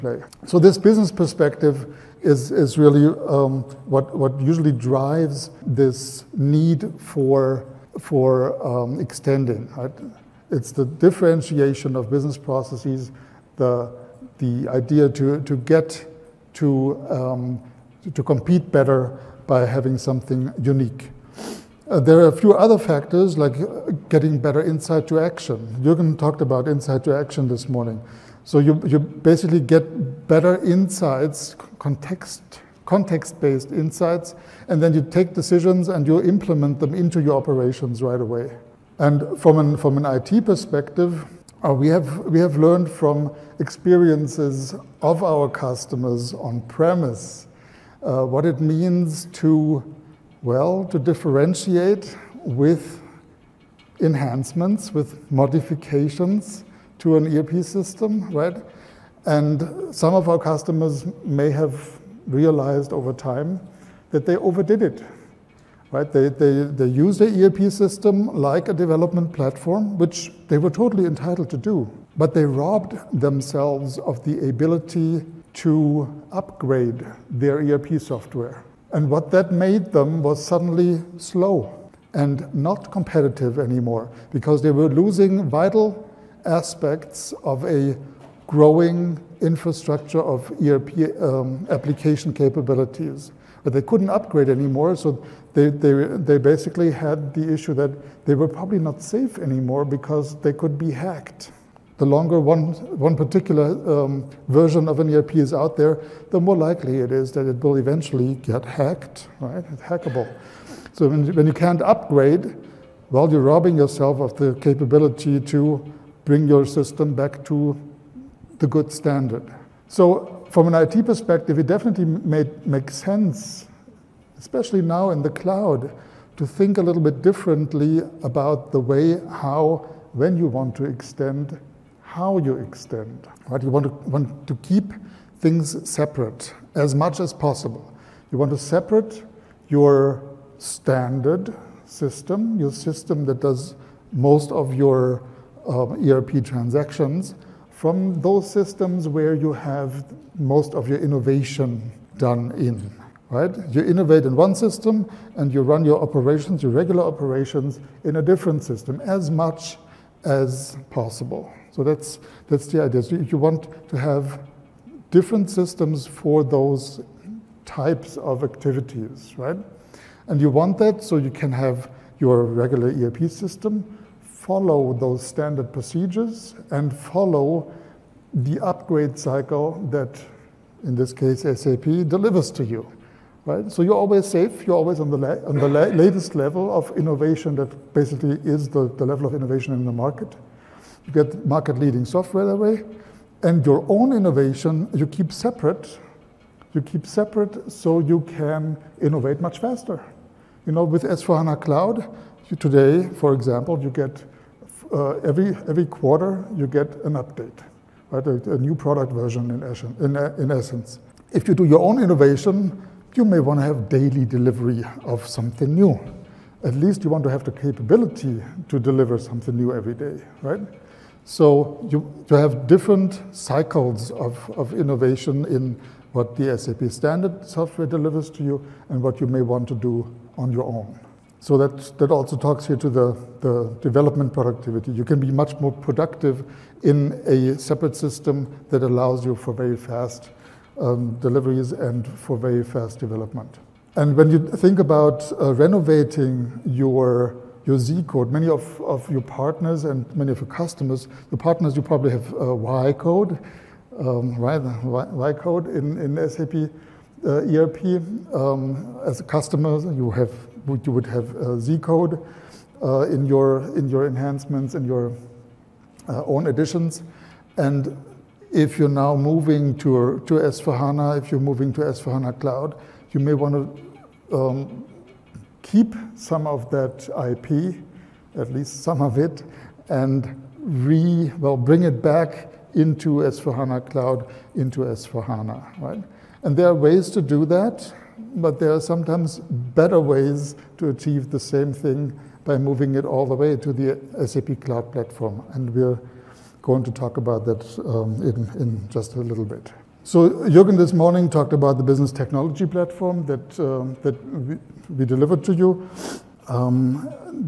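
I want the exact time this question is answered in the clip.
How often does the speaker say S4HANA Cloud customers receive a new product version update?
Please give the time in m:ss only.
3:25.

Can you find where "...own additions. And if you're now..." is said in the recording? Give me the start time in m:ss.
4:26.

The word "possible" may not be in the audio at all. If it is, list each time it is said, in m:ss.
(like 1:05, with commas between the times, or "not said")
2:17, 2:40.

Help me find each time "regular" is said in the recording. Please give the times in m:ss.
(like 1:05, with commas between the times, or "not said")
2:36, 2:52.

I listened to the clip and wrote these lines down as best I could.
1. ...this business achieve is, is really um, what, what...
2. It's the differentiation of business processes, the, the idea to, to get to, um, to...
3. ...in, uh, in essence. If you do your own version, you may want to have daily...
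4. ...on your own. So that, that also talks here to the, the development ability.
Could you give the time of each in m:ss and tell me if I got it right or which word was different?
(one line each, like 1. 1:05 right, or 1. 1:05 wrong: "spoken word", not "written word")
1. 0:00 wrong: "perspective", not "achieve"
2. 0:10 right
3. 3:30 wrong: "innovation", not "version"
4. 3:50 wrong: "productivity", not "ability".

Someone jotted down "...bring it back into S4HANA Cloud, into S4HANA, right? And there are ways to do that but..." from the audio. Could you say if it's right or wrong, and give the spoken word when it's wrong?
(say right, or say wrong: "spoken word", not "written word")
right.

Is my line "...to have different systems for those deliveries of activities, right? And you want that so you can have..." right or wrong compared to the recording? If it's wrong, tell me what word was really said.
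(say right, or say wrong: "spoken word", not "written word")
wrong: "types", not "deliveries".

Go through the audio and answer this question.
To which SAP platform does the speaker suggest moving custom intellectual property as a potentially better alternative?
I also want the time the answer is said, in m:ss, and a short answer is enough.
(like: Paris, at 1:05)
SAP Cloud Platform, at 4:54.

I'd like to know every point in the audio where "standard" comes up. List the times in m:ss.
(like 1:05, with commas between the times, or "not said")
1:58, 2:20, 2:55, 3:46.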